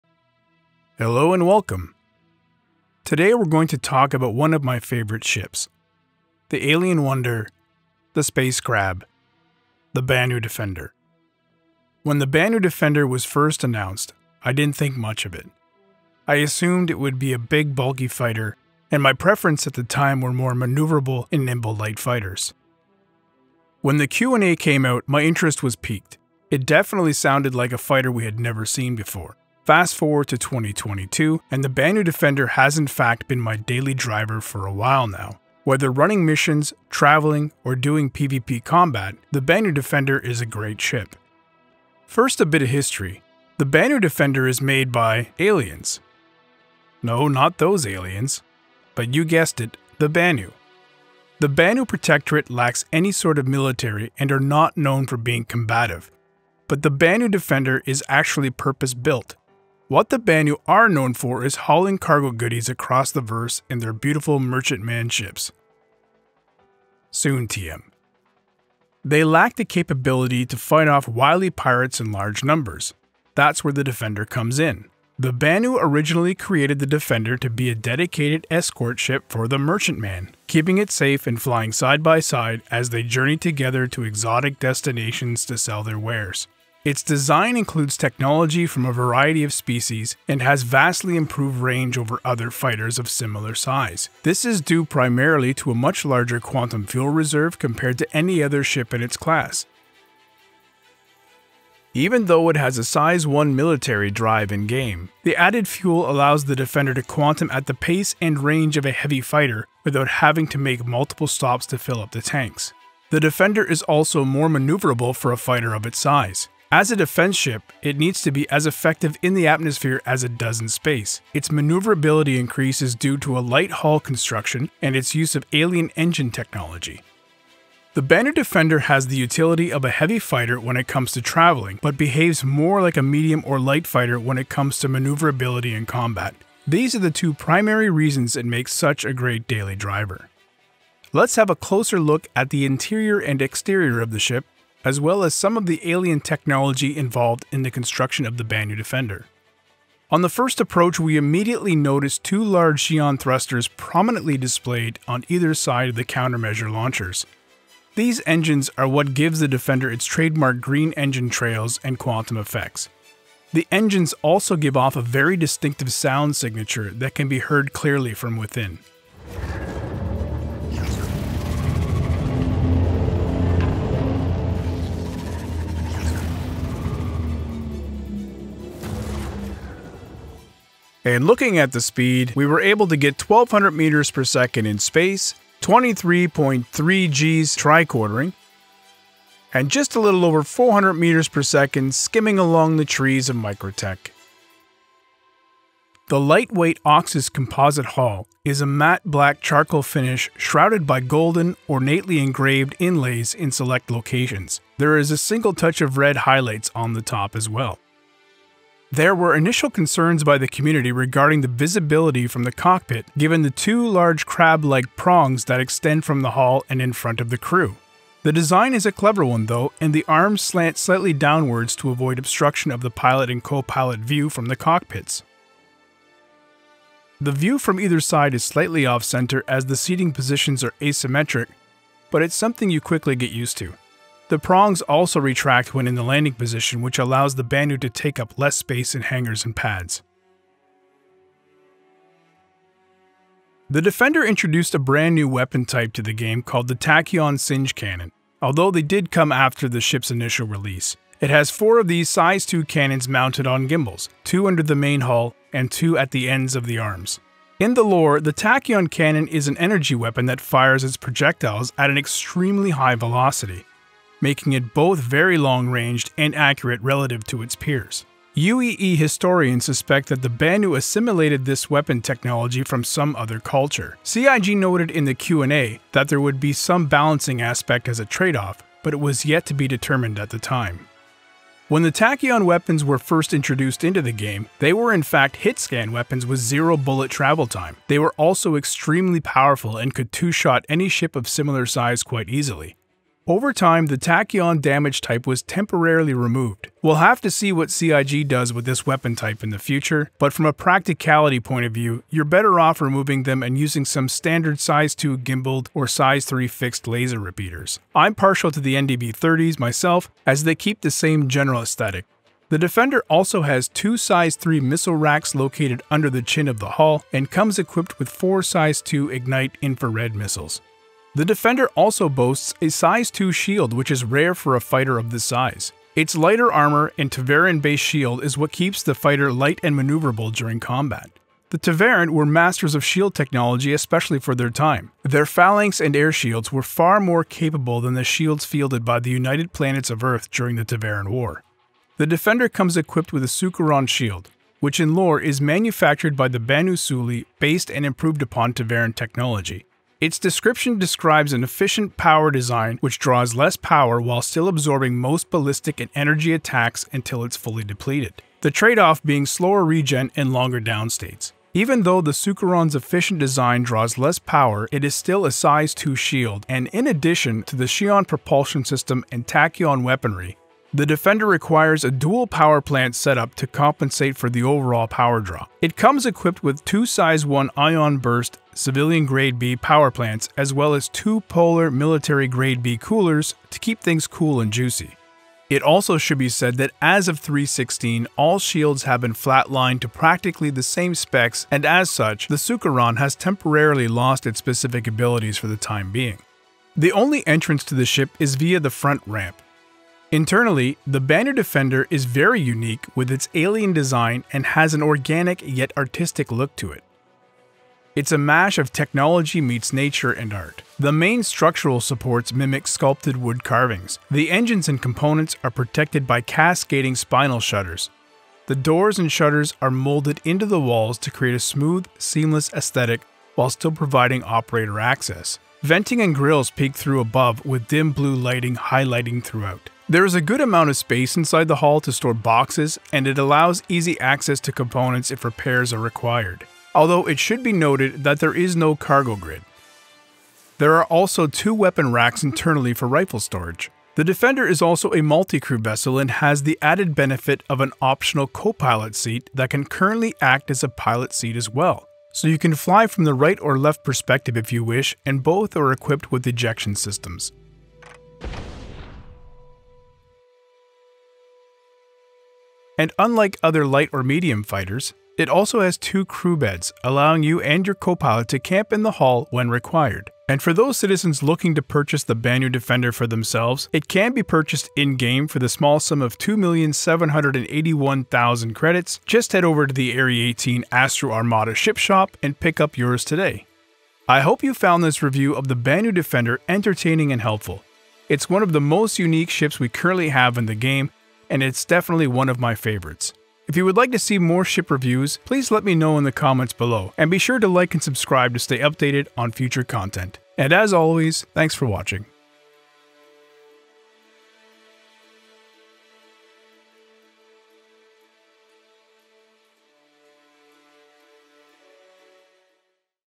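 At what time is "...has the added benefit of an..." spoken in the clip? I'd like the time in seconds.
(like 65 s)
446 s.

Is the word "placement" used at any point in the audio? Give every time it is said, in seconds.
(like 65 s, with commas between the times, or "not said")
not said.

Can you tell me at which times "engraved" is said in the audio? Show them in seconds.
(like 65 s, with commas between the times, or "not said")
202 s.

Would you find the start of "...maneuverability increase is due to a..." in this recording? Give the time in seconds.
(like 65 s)
121 s.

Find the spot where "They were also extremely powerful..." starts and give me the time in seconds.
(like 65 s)
287 s.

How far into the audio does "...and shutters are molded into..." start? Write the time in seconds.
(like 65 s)
418 s.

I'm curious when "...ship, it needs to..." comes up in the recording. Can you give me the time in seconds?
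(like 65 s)
117 s.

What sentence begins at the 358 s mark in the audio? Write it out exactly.
The trade-off being slower regen and longer downstates.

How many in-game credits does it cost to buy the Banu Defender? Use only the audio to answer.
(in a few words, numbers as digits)
2,781,000.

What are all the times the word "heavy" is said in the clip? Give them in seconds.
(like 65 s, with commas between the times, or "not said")
108 s, 129 s.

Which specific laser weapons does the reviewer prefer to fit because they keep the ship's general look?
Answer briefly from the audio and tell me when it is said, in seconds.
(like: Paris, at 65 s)
NDB30s, at 308 s.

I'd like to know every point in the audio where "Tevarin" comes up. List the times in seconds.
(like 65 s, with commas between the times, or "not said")
327 s, 331 s, 340 s, 348 s.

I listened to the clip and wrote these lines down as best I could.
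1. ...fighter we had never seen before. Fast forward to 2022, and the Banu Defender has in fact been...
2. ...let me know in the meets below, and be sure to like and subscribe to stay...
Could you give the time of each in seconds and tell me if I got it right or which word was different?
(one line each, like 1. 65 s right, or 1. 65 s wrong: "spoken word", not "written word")
1. 27 s right
2. 495 s wrong: "comments", not "meets".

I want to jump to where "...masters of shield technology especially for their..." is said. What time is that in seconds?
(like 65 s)
332 s.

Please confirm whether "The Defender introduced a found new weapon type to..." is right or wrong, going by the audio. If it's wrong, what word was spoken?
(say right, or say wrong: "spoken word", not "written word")
wrong: "brand", not "found".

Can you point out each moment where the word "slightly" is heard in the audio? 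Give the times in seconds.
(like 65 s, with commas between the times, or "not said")
220 s, 228 s.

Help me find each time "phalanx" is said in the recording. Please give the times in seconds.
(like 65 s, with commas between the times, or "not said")
335 s.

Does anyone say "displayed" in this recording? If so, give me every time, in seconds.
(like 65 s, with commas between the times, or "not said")
154 s.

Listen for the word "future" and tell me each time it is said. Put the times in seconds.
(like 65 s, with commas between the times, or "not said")
299 s, 499 s.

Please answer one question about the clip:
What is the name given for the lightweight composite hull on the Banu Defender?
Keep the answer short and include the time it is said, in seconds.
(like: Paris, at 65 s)
Oxus, at 196 s.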